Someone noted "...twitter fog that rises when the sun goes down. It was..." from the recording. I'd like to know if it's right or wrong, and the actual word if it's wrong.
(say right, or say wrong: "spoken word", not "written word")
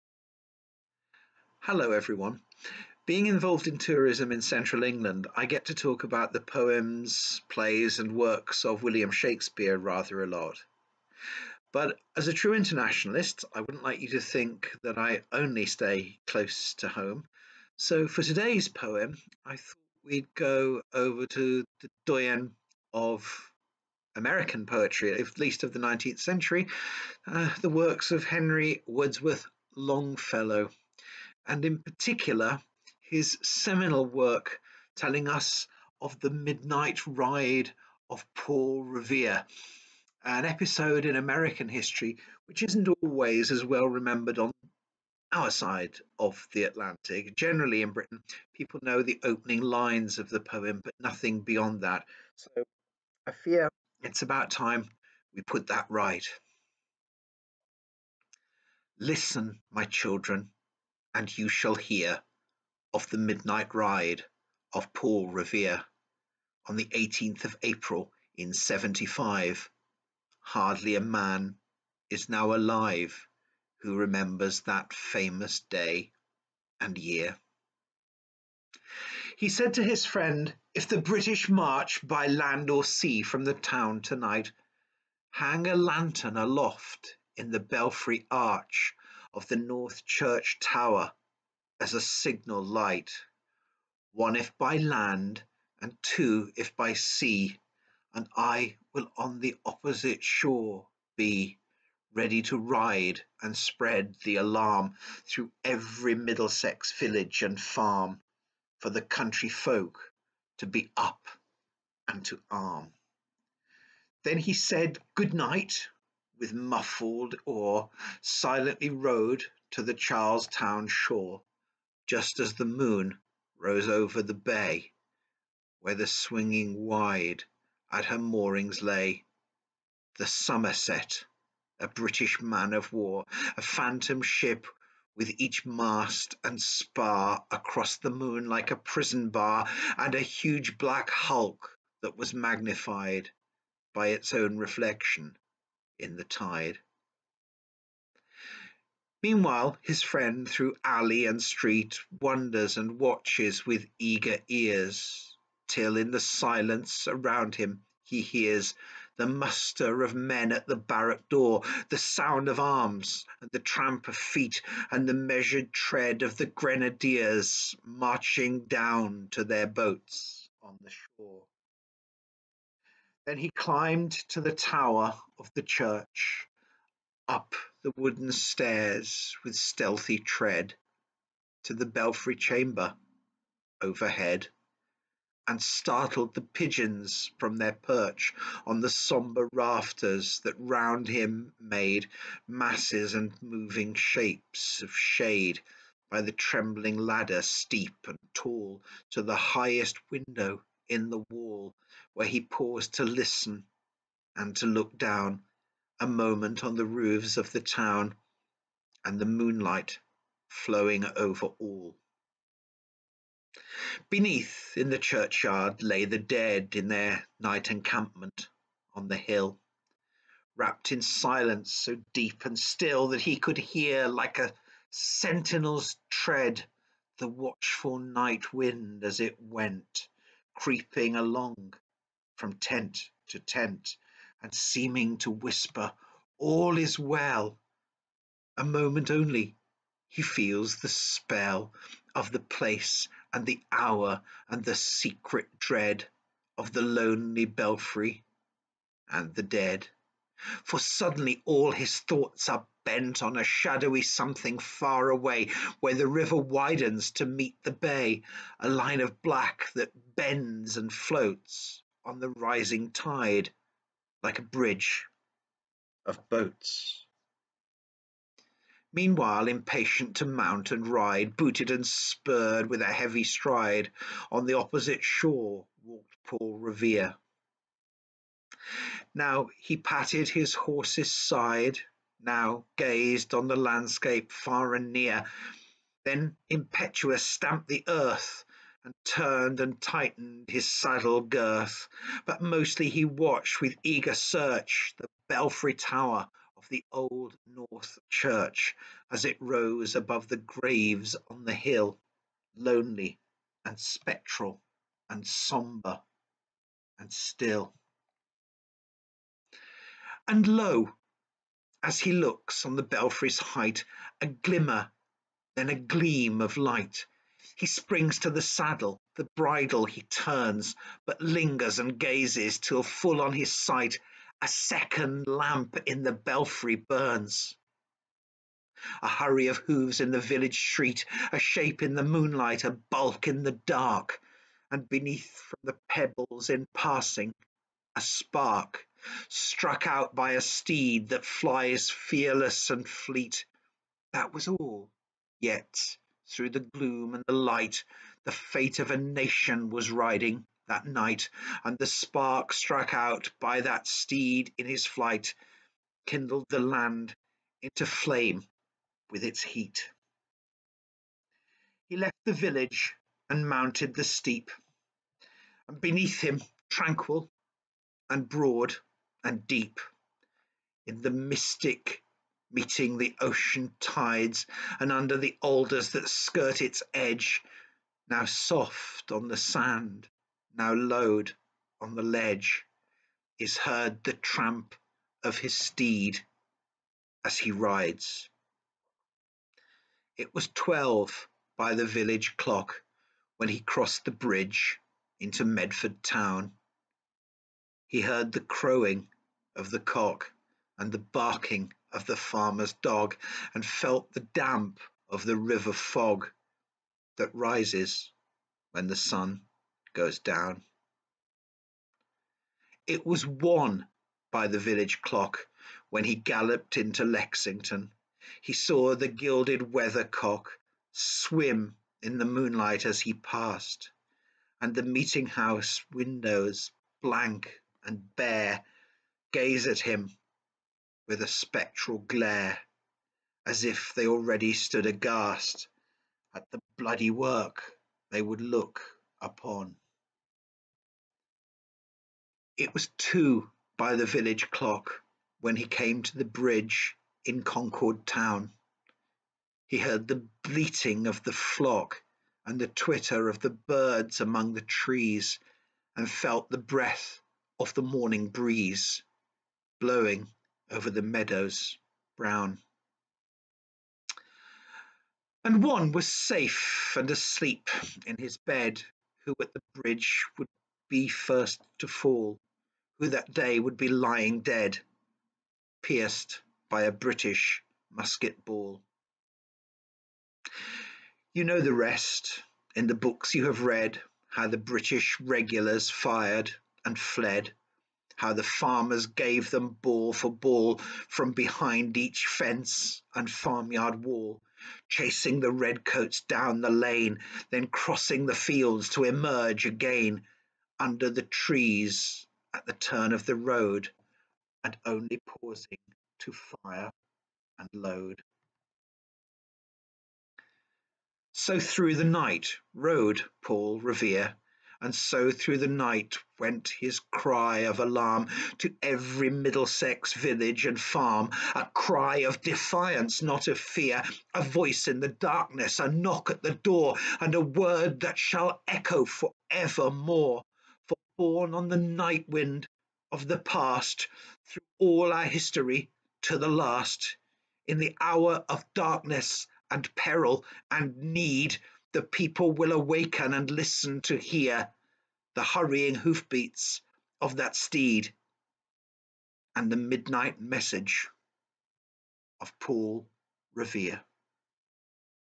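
wrong: "river", not "twitter".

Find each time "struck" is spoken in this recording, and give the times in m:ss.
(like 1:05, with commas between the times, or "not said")
5:39, 5:52.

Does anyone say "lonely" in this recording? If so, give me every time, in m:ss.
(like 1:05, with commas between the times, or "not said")
4:06, 5:02.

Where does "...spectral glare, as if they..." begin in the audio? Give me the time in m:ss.
7:11.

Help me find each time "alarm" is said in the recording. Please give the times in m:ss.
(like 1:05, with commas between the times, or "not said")
1:44, 8:37.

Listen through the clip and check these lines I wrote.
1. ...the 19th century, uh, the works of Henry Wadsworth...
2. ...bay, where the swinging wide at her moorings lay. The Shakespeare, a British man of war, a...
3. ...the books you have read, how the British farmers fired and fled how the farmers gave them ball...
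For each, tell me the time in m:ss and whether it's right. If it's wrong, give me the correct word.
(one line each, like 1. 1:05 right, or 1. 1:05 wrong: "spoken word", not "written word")
1. 0:25 right
2. 2:04 wrong: "Somerset", not "Shakespeare"
3. 8:02 wrong: "regulars", not "farmers".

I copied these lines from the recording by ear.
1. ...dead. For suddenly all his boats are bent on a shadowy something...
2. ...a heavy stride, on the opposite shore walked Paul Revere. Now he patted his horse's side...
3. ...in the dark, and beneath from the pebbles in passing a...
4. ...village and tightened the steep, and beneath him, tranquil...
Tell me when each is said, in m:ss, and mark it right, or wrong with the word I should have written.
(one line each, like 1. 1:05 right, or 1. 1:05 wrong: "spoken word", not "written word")
1. 4:09 wrong: "thoughts", not "boats"
2. 4:32 right
3. 5:33 right
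4. 6:02 wrong: "mounted", not "tightened".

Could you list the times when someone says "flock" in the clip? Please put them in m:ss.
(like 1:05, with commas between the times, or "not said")
7:31.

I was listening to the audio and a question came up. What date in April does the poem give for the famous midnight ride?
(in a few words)
18th of April.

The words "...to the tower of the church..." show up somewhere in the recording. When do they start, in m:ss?
2:54.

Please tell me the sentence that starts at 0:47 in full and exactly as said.
Generally in Britain, people know the opening lines of the poem, but nothing beyond that.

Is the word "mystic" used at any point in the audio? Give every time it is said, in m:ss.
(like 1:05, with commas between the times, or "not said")
6:11.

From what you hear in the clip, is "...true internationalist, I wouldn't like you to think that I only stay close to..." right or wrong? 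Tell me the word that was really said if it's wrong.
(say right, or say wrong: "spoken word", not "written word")
right.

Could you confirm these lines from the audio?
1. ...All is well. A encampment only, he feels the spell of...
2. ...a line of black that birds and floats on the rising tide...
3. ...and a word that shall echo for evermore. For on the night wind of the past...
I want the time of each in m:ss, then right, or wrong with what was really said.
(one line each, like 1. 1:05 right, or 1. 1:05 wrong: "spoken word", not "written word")
1. 3:56 wrong: "moment", not "encampment"
2. 4:18 wrong: "bends", not "birds"
3. 8:47 right.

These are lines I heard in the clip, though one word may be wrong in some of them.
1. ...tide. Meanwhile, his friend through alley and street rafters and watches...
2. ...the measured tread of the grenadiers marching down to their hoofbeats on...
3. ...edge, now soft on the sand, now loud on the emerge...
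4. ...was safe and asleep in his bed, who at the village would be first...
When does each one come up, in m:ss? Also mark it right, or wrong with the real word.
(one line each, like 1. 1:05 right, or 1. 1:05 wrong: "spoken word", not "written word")
1. 2:26 wrong: "wonders", not "rafters"
2. 2:45 wrong: "boats", not "hoofbeats"
3. 6:16 wrong: "ledge", not "emerge"
4. 7:45 wrong: "bridge", not "village".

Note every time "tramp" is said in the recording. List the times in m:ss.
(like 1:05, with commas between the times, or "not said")
2:43, 6:24.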